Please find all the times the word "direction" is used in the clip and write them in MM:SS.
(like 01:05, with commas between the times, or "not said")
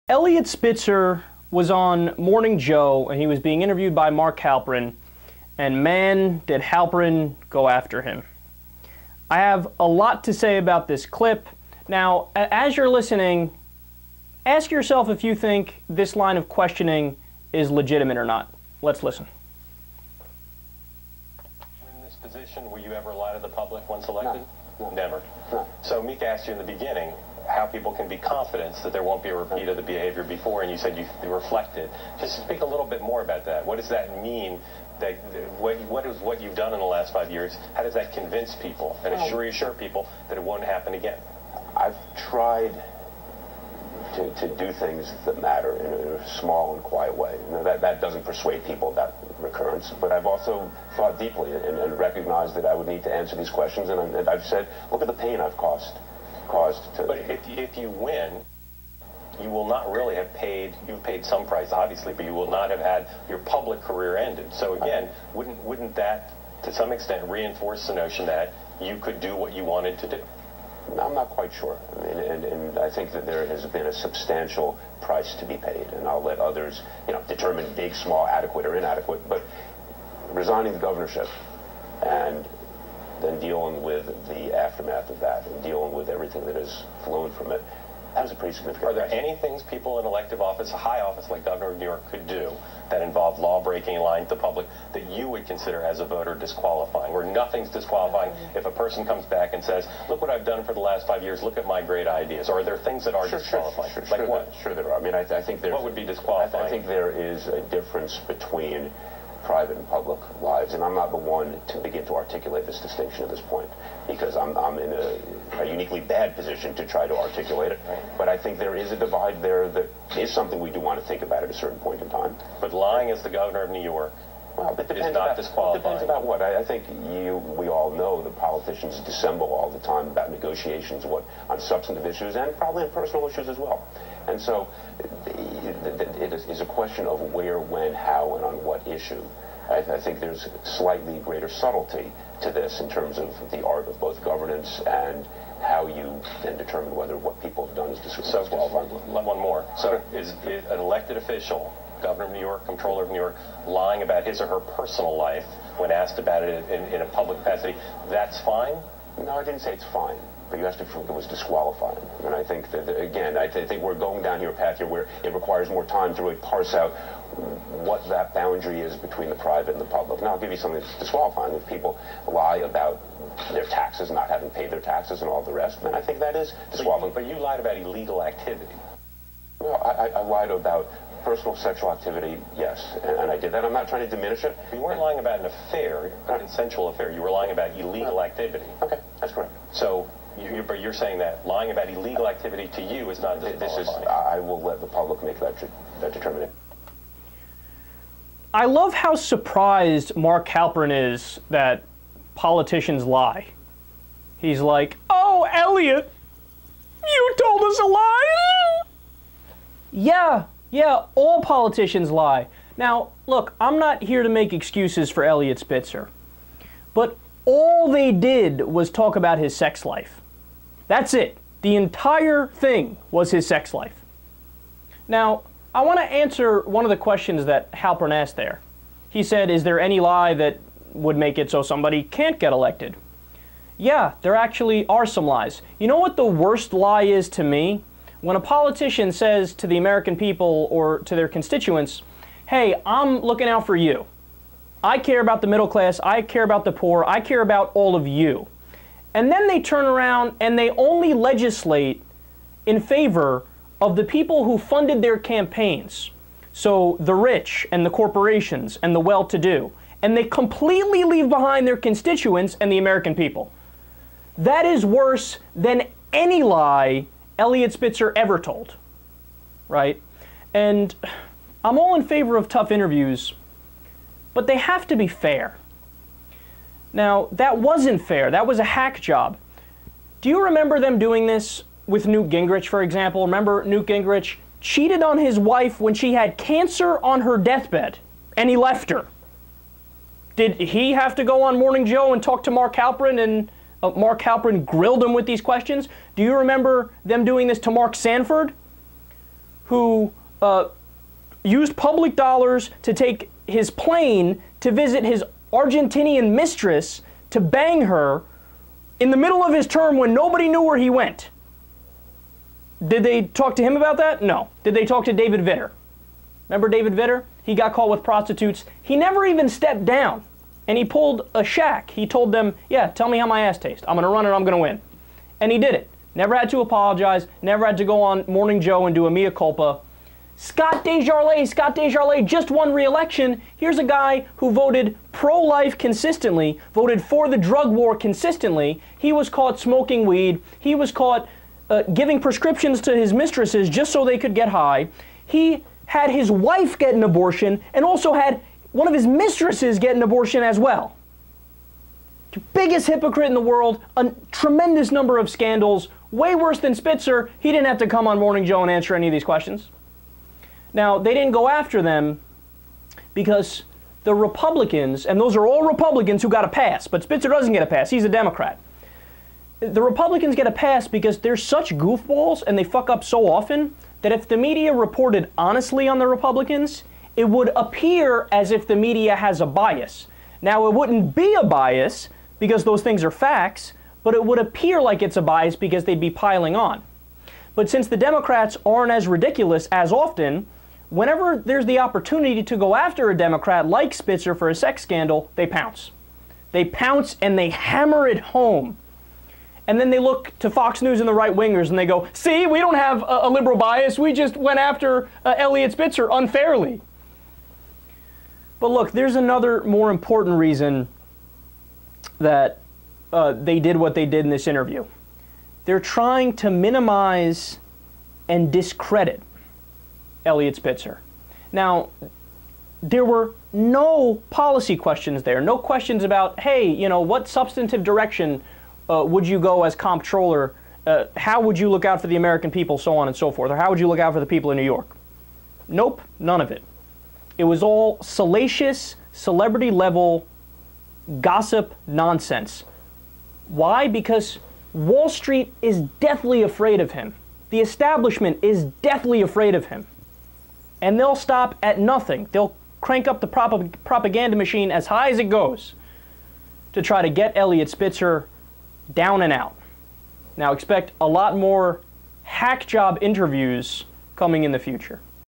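07:07.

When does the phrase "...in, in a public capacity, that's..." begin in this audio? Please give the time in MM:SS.
02:36.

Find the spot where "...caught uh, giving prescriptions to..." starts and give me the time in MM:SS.
05:40.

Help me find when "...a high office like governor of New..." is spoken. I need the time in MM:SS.
01:30.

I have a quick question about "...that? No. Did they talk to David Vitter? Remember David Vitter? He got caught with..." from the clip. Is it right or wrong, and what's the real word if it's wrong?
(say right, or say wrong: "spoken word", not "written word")
right.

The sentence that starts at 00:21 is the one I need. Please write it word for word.
In this position, will you ever lie to the public once elected?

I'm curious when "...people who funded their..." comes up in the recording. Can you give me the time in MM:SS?
04:14.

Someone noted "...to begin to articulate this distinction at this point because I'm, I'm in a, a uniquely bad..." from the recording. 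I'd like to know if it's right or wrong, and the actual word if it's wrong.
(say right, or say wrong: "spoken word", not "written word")
right.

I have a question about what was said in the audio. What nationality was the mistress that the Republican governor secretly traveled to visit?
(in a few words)
Argentinian.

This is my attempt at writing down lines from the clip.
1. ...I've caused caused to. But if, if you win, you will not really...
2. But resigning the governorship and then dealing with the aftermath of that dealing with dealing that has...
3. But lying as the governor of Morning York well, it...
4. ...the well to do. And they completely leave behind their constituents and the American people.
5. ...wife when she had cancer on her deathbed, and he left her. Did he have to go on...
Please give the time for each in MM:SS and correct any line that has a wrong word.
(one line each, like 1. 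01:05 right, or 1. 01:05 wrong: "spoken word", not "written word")
1. 00:55 right
2. 01:19 wrong: "everything", not "dealing"
3. 02:02 wrong: "New", not "Morning"
4. 04:18 right
5. 04:45 right.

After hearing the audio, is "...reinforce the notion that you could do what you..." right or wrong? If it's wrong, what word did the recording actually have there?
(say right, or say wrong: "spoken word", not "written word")
right.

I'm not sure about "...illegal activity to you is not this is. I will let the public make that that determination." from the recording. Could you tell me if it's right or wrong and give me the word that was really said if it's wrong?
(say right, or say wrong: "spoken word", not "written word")
right.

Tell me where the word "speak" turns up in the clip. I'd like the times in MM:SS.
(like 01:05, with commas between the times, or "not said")
00:32.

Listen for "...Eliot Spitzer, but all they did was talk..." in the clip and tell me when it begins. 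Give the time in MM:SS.
03:35.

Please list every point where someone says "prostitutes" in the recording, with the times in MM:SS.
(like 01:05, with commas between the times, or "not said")
05:18.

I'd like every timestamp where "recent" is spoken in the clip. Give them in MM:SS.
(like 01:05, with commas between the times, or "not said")
not said.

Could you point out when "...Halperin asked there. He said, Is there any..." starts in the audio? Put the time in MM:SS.
03:47.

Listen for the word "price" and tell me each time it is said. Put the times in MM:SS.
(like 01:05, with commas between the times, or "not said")
01:01, 01:15.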